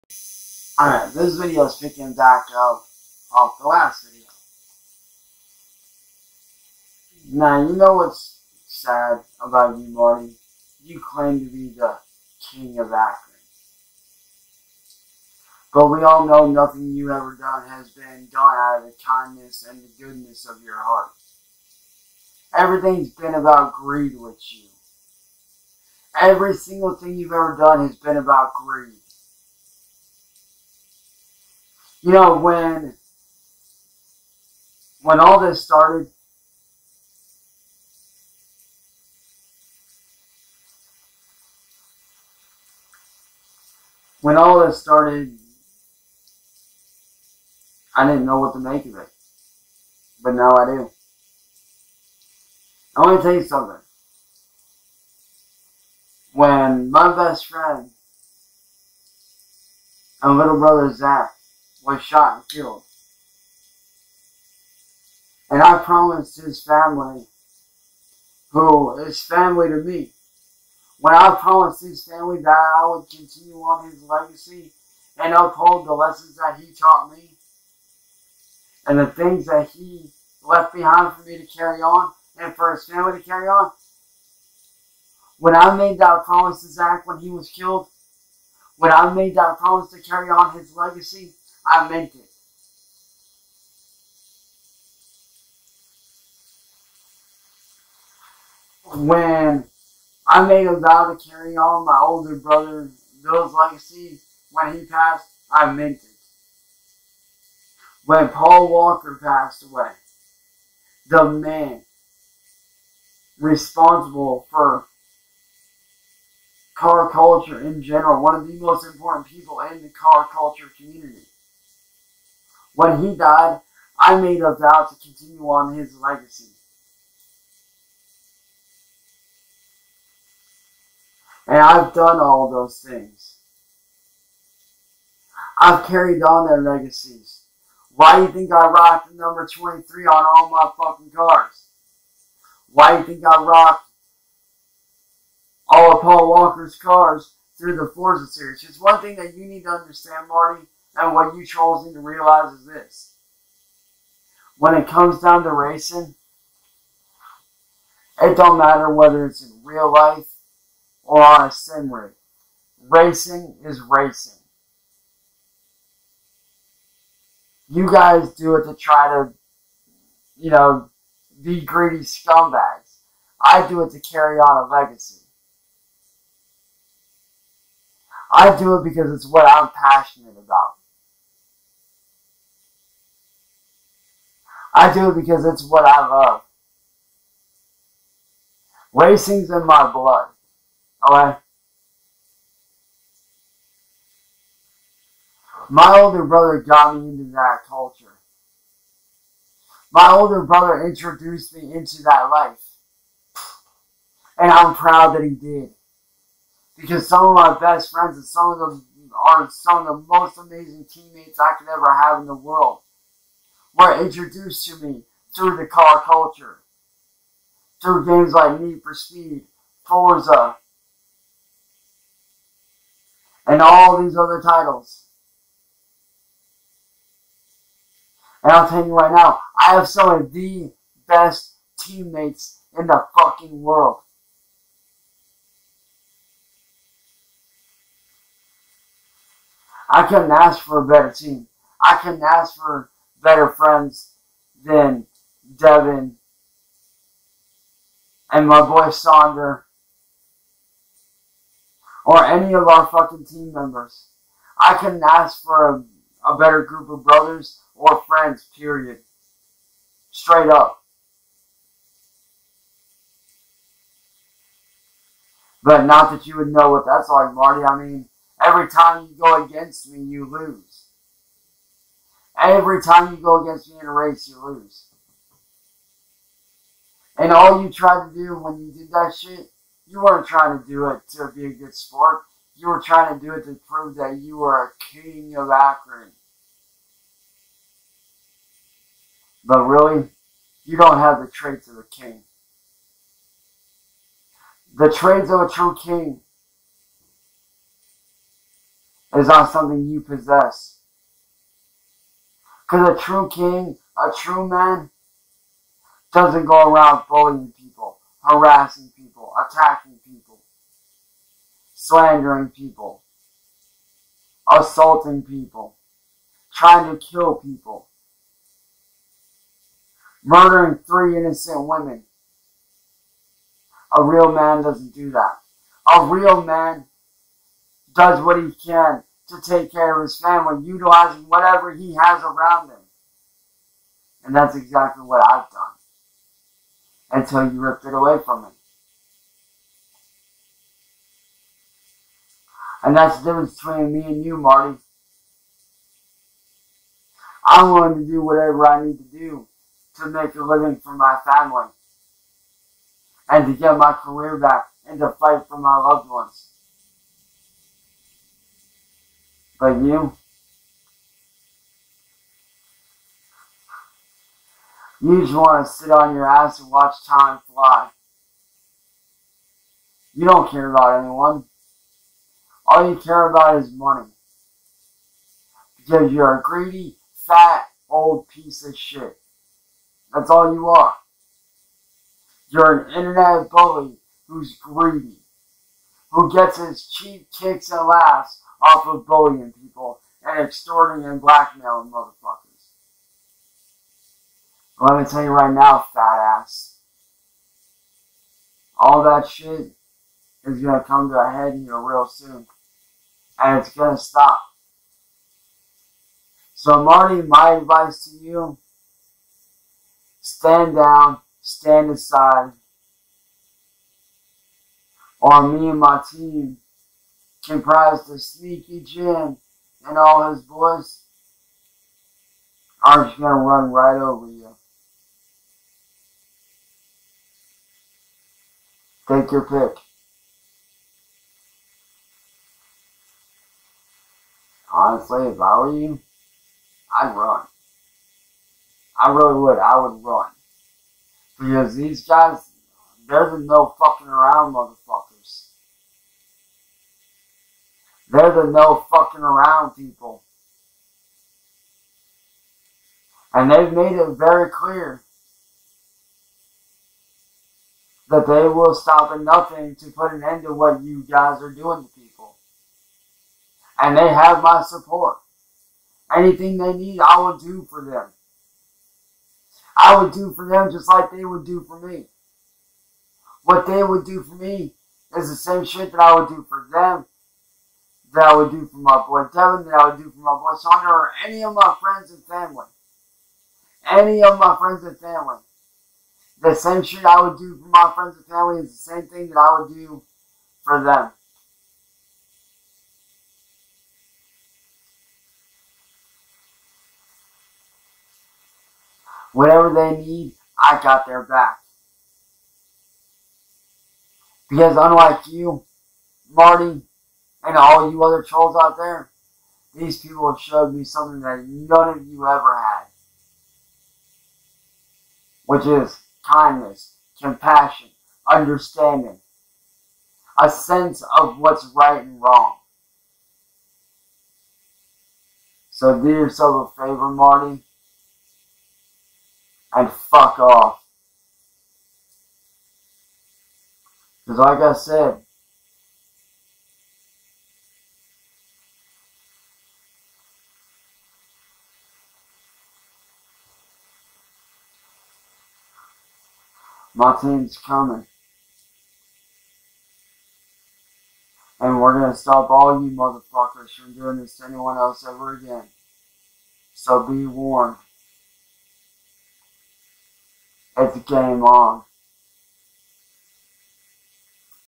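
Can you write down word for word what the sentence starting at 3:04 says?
I do because it's what I love.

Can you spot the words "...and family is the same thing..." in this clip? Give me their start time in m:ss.
8:08.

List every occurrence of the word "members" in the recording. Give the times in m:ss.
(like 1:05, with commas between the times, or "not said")
4:13.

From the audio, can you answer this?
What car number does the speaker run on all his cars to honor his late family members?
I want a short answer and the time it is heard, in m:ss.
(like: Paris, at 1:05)
23, at 2:19.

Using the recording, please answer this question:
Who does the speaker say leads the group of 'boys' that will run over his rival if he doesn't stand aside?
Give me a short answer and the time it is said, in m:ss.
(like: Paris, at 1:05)
Sneaky Jim, at 6:58.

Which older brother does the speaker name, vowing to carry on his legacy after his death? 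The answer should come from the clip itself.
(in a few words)
Bill.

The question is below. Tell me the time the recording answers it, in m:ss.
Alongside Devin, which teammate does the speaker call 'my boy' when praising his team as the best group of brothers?
4:08.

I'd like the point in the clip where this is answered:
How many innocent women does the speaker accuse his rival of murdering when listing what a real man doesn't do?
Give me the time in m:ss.
5:20.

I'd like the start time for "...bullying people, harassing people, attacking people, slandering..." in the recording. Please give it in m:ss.
5:07.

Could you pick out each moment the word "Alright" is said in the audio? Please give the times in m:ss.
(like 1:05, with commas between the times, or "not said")
0:00.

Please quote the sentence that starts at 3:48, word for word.
And I'll tell you right now, I have some of the best teammates in the fucking world.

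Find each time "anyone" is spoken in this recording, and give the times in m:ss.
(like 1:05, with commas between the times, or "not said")
6:10, 9:14.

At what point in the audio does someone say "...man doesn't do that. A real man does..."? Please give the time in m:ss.
5:24.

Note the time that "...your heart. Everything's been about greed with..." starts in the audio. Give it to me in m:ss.
0:20.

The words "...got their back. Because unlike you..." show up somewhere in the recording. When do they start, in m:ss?
8:20.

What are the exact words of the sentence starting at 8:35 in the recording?
Which is kindness, compassion, understanding, a sense of what's right and wrong.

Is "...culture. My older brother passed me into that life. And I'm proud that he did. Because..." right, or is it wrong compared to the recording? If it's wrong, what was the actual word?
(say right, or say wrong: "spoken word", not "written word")
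wrong: "introduced", not "passed".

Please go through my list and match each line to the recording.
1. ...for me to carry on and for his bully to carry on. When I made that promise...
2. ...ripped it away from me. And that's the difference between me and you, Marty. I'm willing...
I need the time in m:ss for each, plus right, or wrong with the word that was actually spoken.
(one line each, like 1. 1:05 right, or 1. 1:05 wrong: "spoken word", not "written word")
1. 1:21 wrong: "family", not "bully"
2. 5:37 right.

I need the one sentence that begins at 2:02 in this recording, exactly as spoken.
When he died, I made a vow to continue on his legacy.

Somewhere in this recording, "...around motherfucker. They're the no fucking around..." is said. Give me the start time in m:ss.
7:24.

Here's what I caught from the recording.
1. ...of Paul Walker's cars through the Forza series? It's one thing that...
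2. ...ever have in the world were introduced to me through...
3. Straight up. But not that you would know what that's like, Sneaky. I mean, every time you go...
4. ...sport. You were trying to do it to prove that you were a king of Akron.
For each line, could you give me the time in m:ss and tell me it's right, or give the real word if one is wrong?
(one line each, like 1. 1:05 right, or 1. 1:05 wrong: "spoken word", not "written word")
1. 2:25 right
2. 3:31 right
3. 4:20 wrong: "Marty", not "Sneaky"
4. 4:41 right.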